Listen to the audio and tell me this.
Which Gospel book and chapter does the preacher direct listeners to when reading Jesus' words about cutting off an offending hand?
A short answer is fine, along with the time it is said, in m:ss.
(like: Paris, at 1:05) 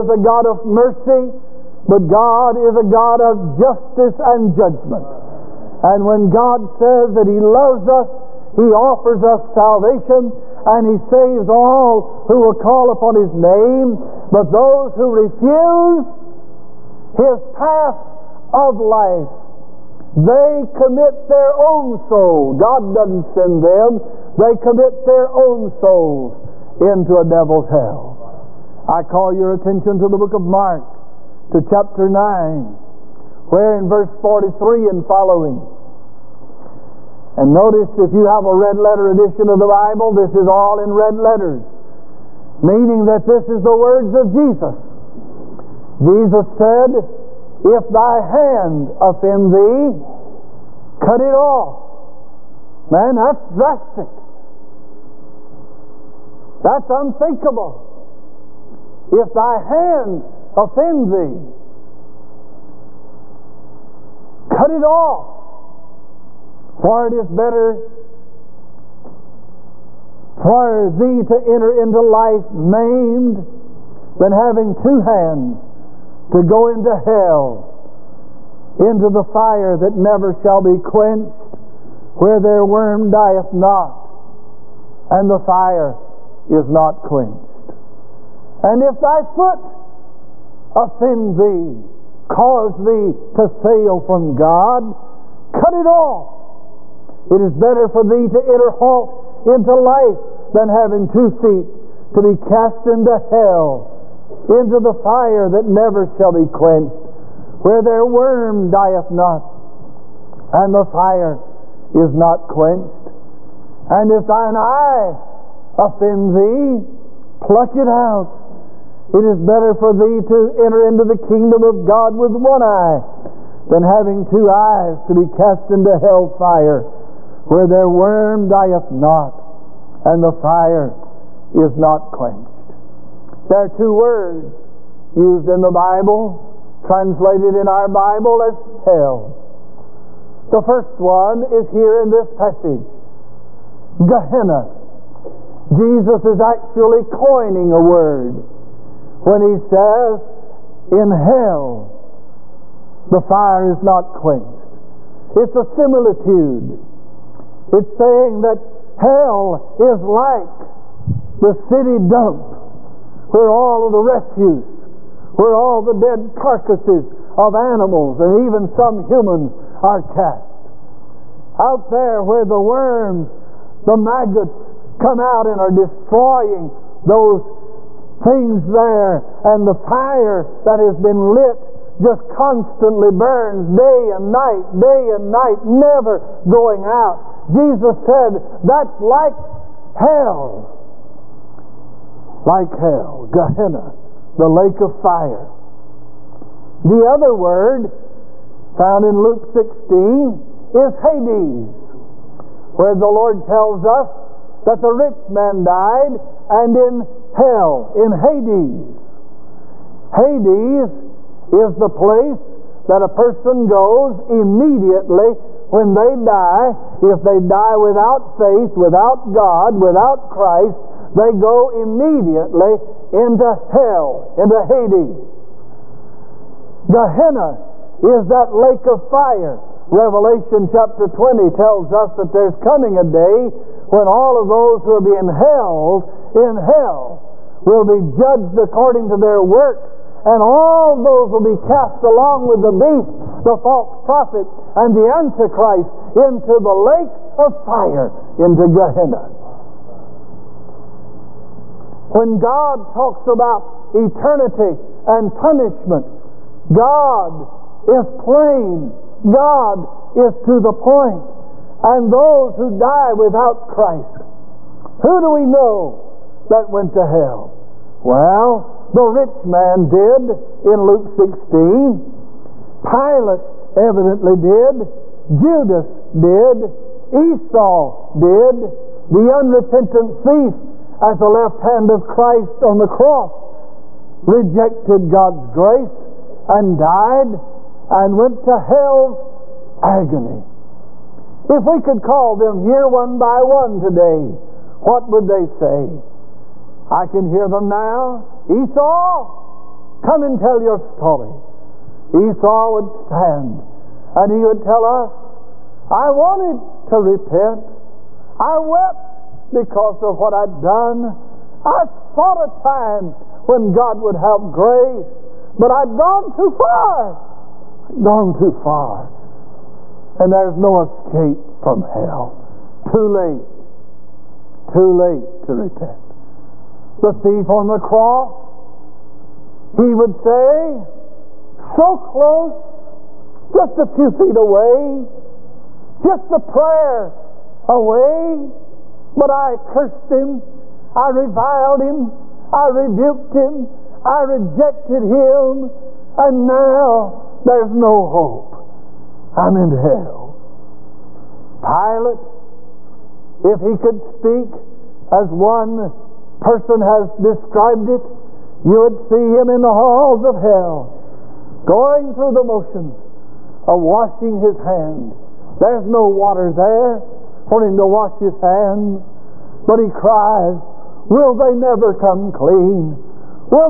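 Mark chapter 9, at 0:30.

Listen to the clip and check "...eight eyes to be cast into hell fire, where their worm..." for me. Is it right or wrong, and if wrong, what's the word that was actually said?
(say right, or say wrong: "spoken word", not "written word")
wrong: "two", not "eight".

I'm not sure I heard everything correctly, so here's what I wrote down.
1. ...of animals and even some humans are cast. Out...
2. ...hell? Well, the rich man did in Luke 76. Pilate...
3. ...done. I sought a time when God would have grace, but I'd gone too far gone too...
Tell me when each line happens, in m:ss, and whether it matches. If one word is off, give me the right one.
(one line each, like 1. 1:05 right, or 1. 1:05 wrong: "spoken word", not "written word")
1. 2:47 right
2. 4:27 wrong: "16", not "76"
3. 5:10 right.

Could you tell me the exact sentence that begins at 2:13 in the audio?
There are two words used in the Bible, translated in our Bible as hell.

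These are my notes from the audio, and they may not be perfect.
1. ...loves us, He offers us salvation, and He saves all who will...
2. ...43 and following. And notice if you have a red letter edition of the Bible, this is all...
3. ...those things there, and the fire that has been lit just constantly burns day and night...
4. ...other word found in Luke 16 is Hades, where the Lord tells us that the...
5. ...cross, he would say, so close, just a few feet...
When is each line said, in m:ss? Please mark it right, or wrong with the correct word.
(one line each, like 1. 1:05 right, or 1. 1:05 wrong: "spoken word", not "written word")
1. 0:07 right
2. 0:34 right
3. 2:57 right
4. 3:17 right
5. 5:27 right.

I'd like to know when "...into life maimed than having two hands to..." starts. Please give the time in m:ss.
1:11.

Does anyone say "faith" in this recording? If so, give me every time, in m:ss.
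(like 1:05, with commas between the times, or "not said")
3:38.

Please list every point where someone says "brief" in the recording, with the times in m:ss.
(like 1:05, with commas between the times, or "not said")
not said.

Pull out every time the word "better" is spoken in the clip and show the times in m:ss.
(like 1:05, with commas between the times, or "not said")
1:07, 1:37, 1:59.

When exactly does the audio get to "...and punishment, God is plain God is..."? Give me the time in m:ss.
4:15.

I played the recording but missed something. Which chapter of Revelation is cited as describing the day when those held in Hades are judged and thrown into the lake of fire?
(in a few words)
Revelation chapter 20.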